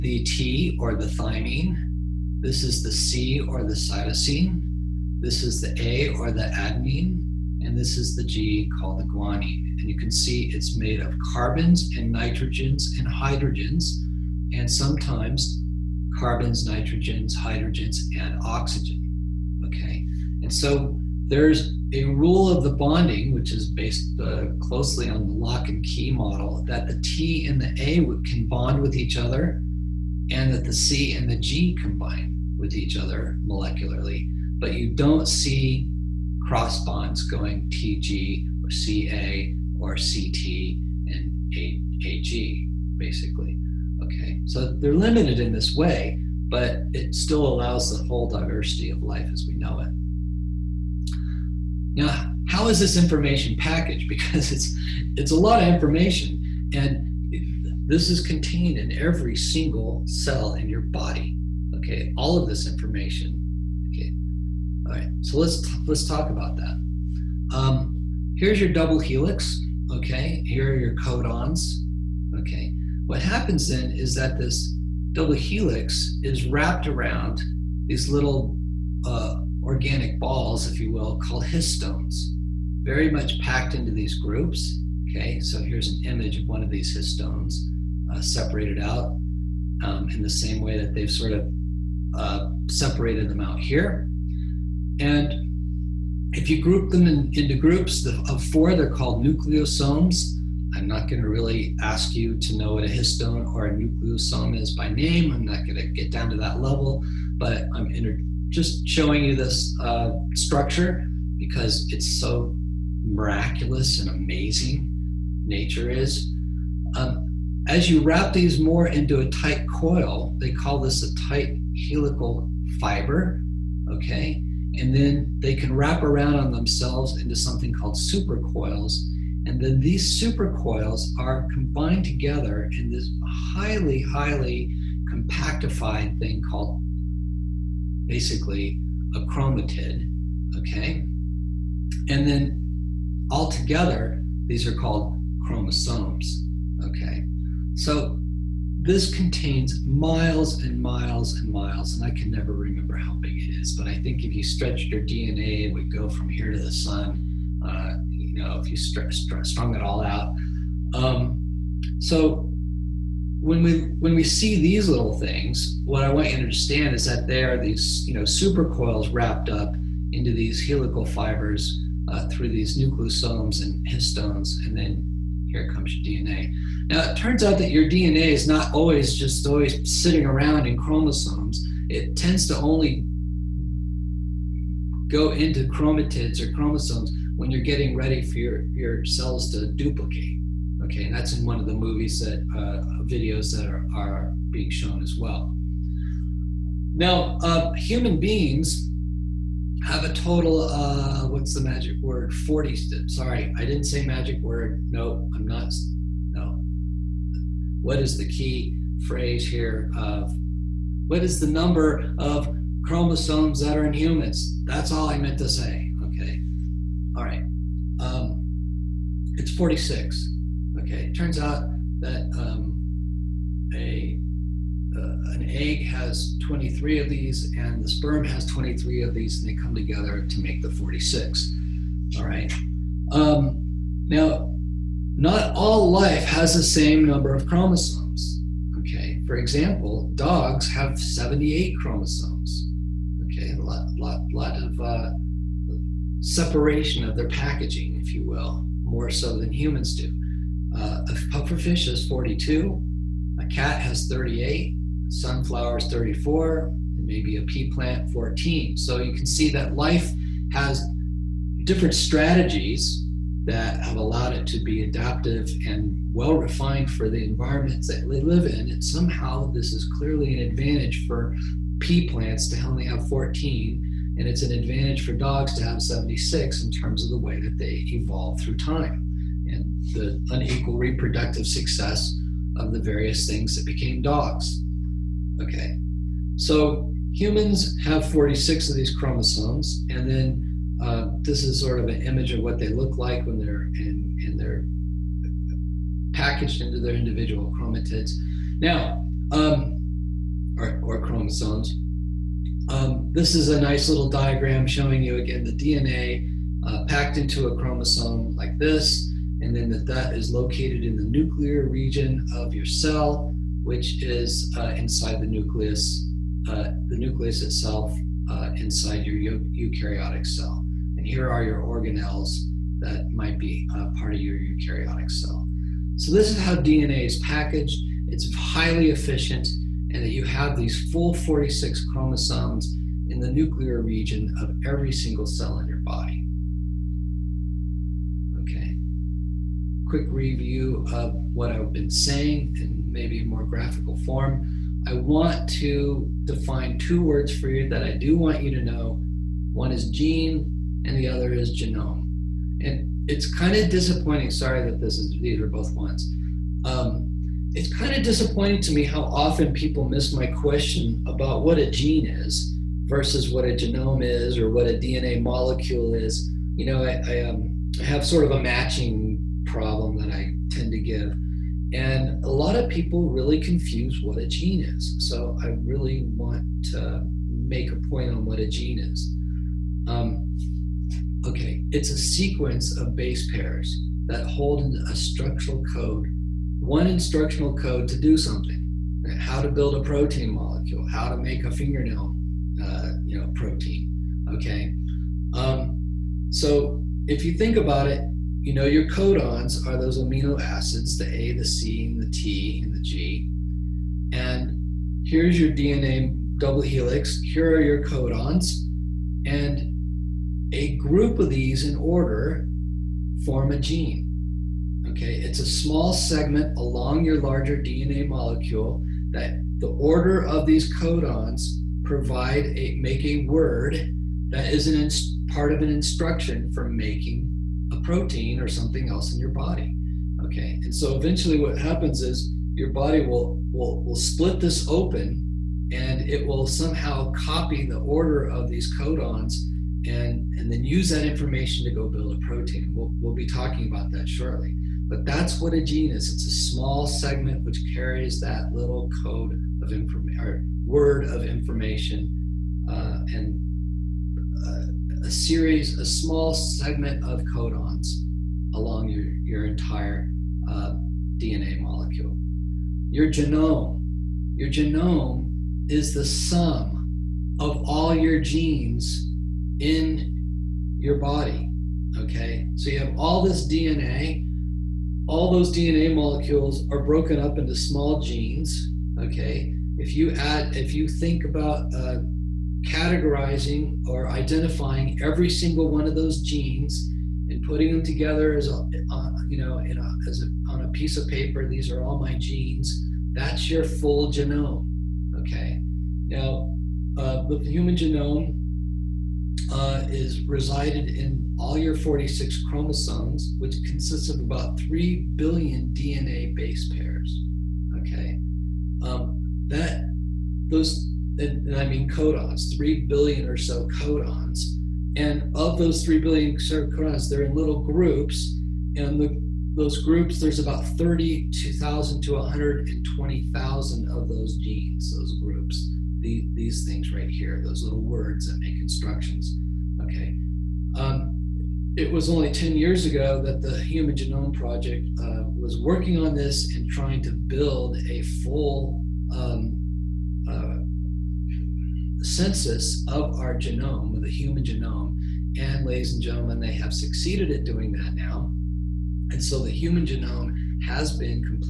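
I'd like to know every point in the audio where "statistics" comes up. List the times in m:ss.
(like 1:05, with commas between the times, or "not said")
not said.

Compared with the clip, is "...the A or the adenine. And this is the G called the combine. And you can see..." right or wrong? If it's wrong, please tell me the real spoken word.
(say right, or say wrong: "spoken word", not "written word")
wrong: "guanine", not "combine".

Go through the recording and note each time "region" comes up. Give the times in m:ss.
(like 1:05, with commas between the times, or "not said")
5:11, 5:33.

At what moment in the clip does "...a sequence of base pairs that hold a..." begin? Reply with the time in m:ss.
6:21.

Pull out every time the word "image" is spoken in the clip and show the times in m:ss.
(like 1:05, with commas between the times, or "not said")
1:26, 4:52.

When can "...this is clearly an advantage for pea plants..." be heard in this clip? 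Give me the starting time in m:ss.
4:29.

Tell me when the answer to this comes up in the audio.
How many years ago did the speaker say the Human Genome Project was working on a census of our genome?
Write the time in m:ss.
8:52.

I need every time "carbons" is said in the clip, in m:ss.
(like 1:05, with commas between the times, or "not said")
0:11, 0:16.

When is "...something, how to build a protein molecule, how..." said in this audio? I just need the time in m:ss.
6:28.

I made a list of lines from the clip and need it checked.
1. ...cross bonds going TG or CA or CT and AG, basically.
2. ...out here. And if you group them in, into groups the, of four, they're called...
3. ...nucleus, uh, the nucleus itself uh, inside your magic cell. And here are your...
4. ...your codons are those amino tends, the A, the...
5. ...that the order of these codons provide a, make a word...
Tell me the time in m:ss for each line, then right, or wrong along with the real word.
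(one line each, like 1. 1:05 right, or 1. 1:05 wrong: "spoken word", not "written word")
1. 0:36 right
2. 1:33 right
3. 5:15 wrong: "eukaryotic", not "magic"
4. 6:38 wrong: "acids", not "tends"
5. 6:59 right.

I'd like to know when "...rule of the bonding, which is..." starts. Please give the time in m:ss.
0:22.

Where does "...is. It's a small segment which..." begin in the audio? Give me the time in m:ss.
7:25.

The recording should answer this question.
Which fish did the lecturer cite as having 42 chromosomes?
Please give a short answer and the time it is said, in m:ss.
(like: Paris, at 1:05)
pufferfish, at 4:11.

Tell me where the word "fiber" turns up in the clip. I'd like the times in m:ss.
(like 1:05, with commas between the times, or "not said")
2:02, 2:51.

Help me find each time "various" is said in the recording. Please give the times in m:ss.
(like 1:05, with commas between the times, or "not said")
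4:42.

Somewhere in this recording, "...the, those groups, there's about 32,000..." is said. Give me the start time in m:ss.
8:38.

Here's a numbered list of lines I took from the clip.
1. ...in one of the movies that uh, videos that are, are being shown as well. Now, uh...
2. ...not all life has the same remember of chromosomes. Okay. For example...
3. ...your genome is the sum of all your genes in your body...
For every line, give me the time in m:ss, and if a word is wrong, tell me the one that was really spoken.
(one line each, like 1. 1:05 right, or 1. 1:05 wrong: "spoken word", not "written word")
1. 3:11 right
2. 3:55 wrong: "number", not "remember"
3. 7:44 right.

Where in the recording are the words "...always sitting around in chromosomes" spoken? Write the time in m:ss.
2:59.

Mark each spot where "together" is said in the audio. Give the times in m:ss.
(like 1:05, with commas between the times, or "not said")
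2:12, 2:23, 3:49, 8:07.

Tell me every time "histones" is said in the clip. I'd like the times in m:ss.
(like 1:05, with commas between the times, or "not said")
1:21, 1:26, 1:42, 2:53.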